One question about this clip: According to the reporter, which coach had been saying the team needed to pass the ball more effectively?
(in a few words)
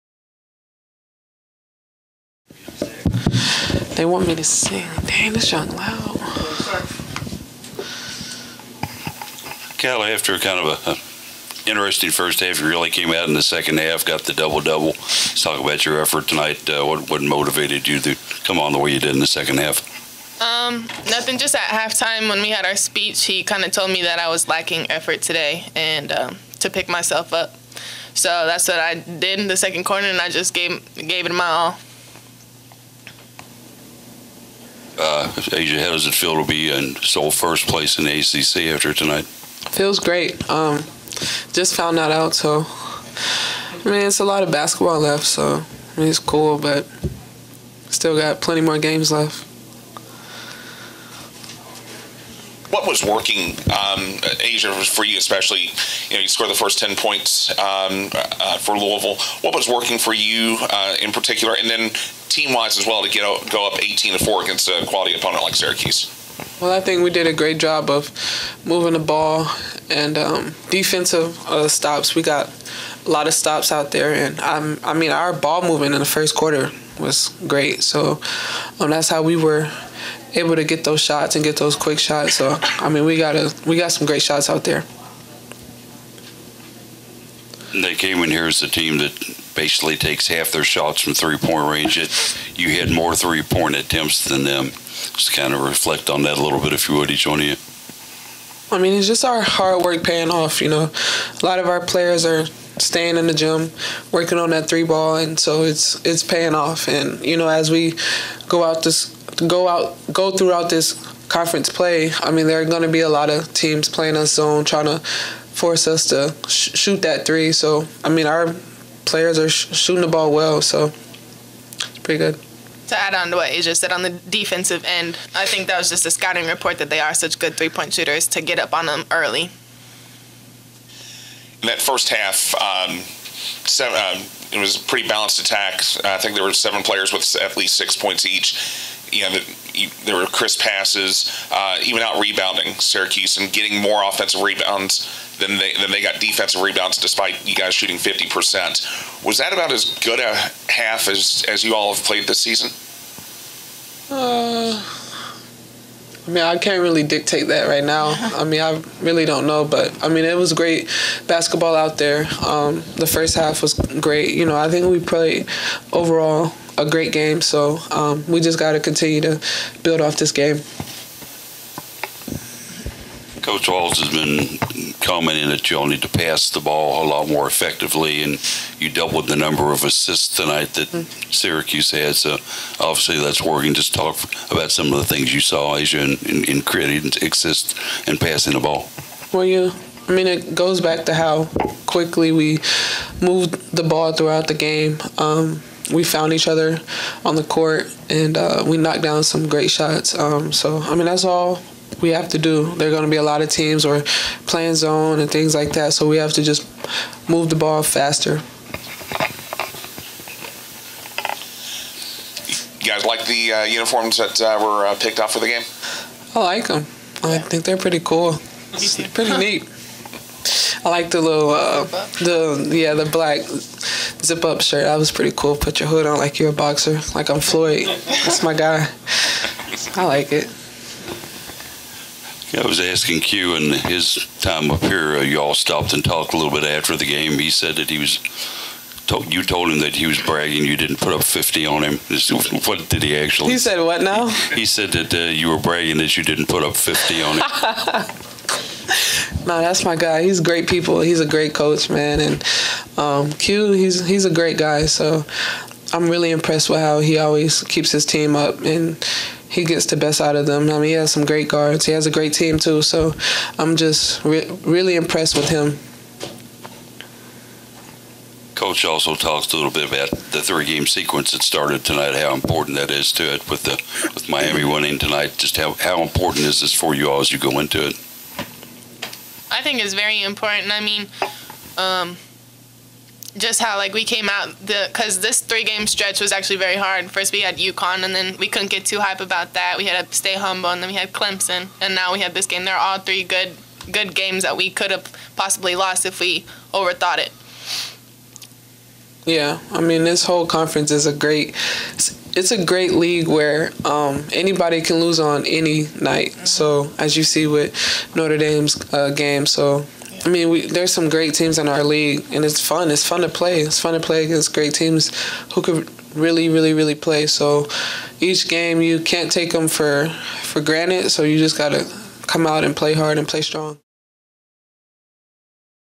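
Coach Walz.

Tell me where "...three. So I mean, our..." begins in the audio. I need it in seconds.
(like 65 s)
117 s.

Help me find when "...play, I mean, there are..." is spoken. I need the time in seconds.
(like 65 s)
111 s.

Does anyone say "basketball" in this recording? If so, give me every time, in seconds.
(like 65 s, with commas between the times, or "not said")
44 s, 161 s.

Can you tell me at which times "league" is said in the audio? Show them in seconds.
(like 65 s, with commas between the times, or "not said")
302 s, 311 s.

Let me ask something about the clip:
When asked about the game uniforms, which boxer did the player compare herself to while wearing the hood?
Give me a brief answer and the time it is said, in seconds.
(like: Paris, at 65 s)
Floyd, at 227 s.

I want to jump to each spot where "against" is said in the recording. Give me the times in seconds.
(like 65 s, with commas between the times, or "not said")
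64 s, 314 s.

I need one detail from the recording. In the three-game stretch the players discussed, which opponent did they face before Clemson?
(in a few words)
UConn.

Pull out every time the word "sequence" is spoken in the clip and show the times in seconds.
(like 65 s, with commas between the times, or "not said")
270 s.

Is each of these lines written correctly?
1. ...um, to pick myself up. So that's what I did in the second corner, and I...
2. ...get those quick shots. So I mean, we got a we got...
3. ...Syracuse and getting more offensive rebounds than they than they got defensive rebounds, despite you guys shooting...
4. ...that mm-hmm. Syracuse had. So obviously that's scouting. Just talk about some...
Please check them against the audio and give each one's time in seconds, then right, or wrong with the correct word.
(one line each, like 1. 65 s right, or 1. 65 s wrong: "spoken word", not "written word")
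1. 26 s right
2. 81 s right
3. 142 s right
4. 180 s wrong: "working", not "scouting".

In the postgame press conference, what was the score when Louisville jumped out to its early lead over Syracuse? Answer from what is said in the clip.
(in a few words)
18 to 4.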